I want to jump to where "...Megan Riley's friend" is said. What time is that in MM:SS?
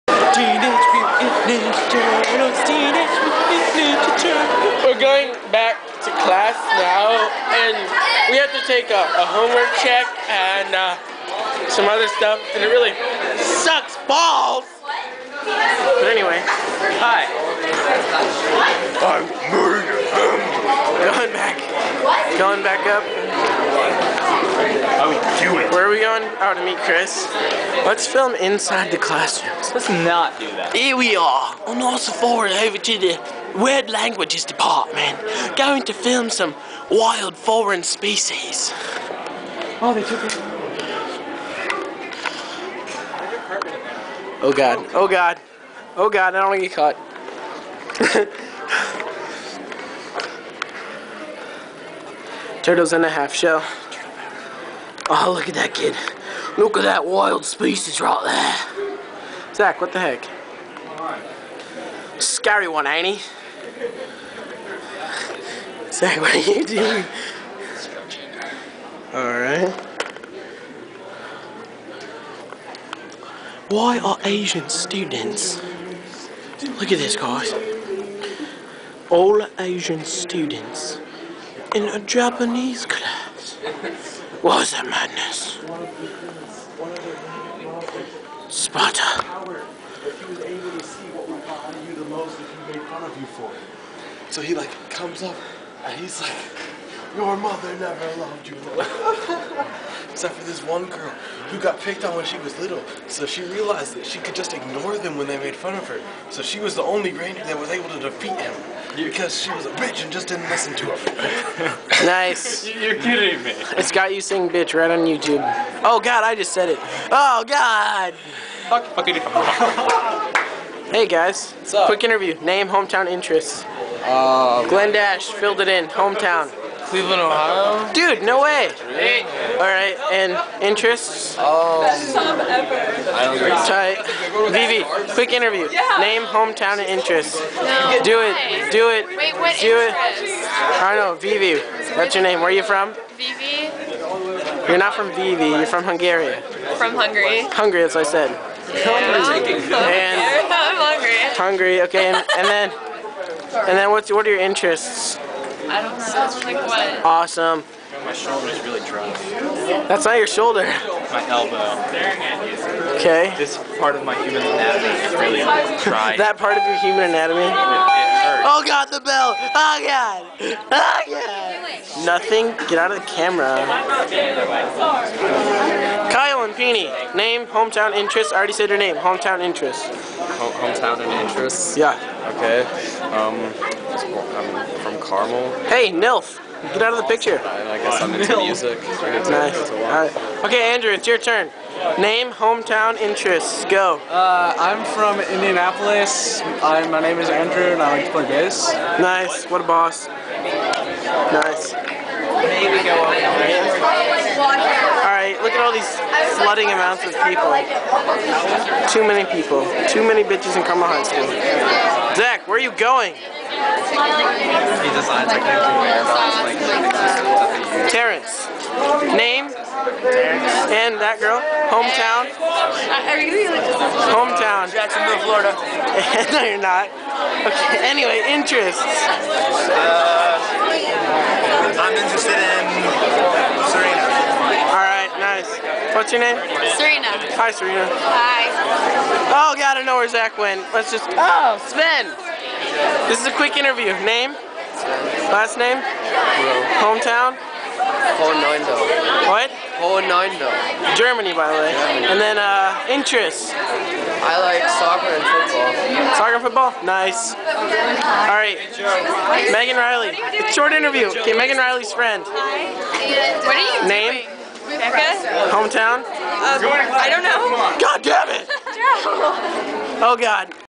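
04:21.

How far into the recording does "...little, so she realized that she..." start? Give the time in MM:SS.
01:42.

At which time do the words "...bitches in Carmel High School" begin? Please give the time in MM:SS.
03:30.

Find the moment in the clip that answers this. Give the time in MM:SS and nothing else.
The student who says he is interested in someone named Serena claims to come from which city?
03:44.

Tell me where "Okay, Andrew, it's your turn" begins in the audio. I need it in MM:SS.
03:10.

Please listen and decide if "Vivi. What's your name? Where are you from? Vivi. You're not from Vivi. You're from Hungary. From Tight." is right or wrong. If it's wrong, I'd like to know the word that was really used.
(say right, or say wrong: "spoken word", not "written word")
wrong: "Hungary", not "Tight".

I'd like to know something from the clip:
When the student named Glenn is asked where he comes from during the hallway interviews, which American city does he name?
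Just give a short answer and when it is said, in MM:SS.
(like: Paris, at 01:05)
Cleveland, Ohio, at 02:06.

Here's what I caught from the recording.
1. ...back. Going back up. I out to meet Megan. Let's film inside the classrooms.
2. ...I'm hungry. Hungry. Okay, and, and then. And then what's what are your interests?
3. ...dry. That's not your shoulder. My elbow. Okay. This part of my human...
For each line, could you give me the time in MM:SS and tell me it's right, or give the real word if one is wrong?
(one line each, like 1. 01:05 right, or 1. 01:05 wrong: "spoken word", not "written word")
1. 00:21 wrong: "Chris", not "Megan"
2. 02:30 right
3. 02:38 right.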